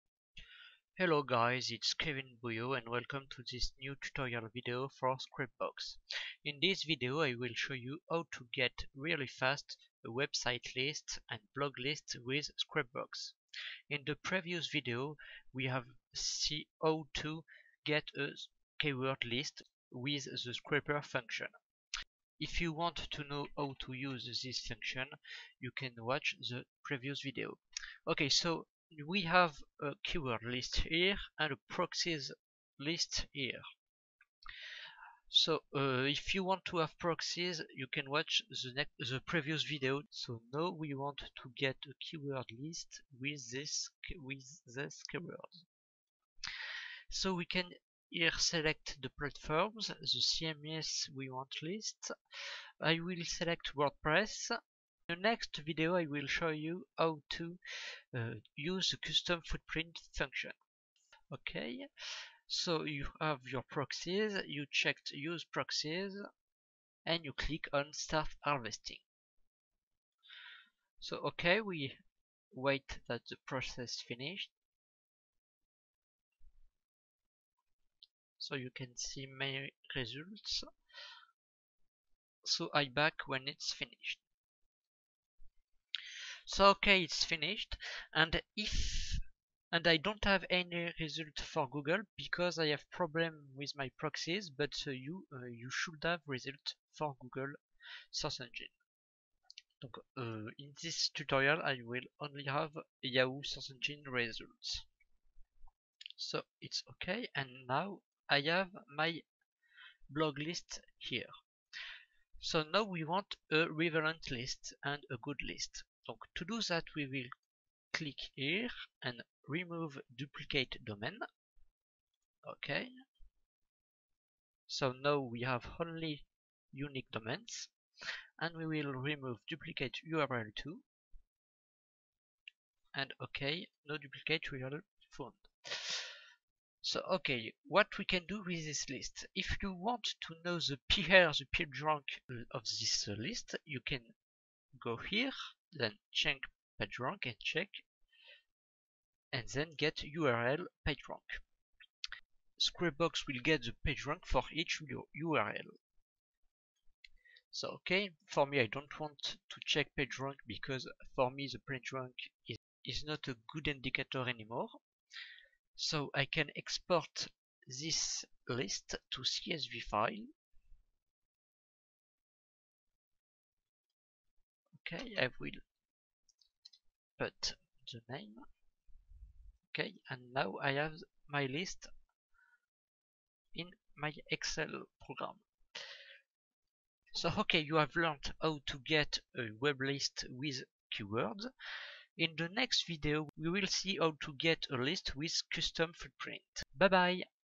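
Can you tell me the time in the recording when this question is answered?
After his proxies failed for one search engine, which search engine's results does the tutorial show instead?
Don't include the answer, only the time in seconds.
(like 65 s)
103 s.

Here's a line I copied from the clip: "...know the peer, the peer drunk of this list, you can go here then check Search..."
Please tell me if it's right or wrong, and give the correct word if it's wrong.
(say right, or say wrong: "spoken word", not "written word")
wrong: "PageRank", not "Search".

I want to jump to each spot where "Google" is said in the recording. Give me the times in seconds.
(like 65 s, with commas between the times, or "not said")
91 s, 97 s.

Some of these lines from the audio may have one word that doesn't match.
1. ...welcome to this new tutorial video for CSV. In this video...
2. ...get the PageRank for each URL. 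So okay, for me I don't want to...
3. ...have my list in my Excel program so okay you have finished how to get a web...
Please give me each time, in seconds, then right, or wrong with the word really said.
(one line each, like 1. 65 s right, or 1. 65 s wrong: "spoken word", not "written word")
1. 2 s wrong: "Scrapebox", not "CSV"
2. 153 s right
3. 180 s wrong: "learned", not "finished".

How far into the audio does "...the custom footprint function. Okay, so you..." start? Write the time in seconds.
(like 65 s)
58 s.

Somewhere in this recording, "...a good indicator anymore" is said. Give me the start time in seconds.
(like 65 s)
163 s.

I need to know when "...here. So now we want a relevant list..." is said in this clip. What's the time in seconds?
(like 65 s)
110 s.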